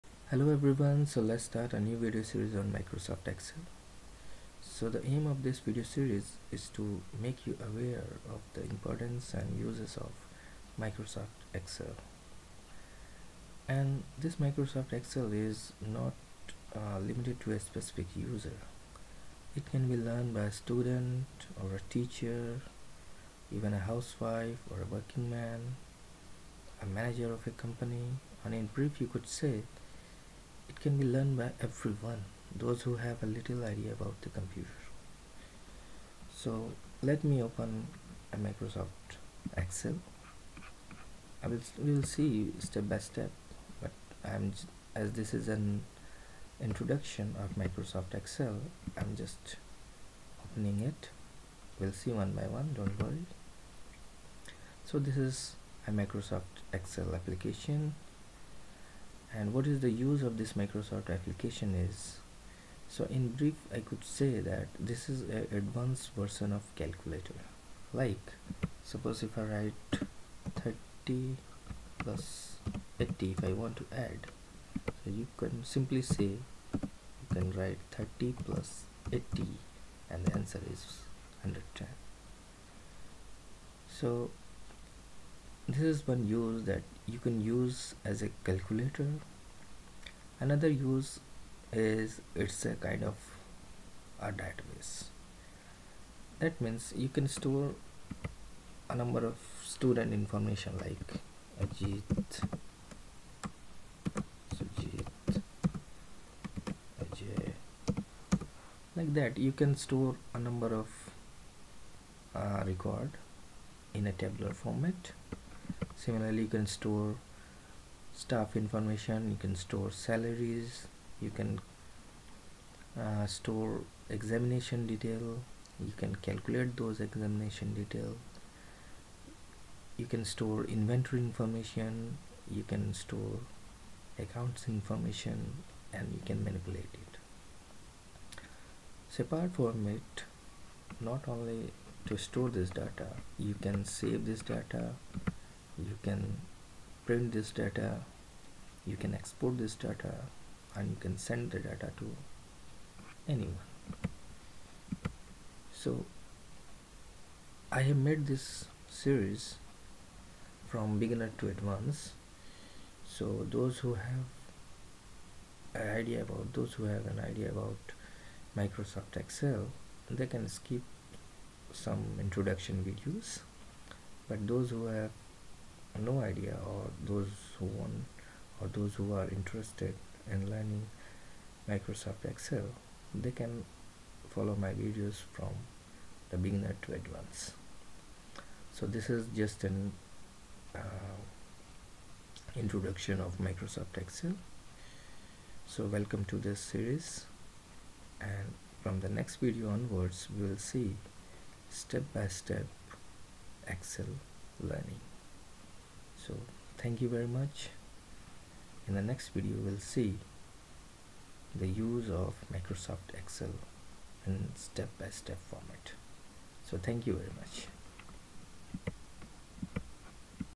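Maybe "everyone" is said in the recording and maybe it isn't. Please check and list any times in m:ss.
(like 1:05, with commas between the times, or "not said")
0:00, 0:31.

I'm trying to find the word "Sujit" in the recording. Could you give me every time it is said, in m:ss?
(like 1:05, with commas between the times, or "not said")
1:44.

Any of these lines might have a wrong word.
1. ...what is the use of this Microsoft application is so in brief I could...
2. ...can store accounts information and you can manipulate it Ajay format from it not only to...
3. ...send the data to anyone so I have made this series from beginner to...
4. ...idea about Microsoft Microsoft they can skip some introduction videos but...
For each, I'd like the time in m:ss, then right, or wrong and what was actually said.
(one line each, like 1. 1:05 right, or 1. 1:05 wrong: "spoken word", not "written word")
1. 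0:59 right
2. 2:12 wrong: "Separate", not "Ajay"
3. 2:31 right
4. 2:47 wrong: "Excel", not "Microsoft".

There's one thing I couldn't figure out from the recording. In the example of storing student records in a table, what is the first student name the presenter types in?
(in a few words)
Ajit.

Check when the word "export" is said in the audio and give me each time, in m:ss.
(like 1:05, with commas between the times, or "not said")
2:29.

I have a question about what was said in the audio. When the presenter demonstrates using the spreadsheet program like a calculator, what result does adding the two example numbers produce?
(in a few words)
110.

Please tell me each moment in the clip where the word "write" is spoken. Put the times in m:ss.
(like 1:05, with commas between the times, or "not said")
1:09, 1:17.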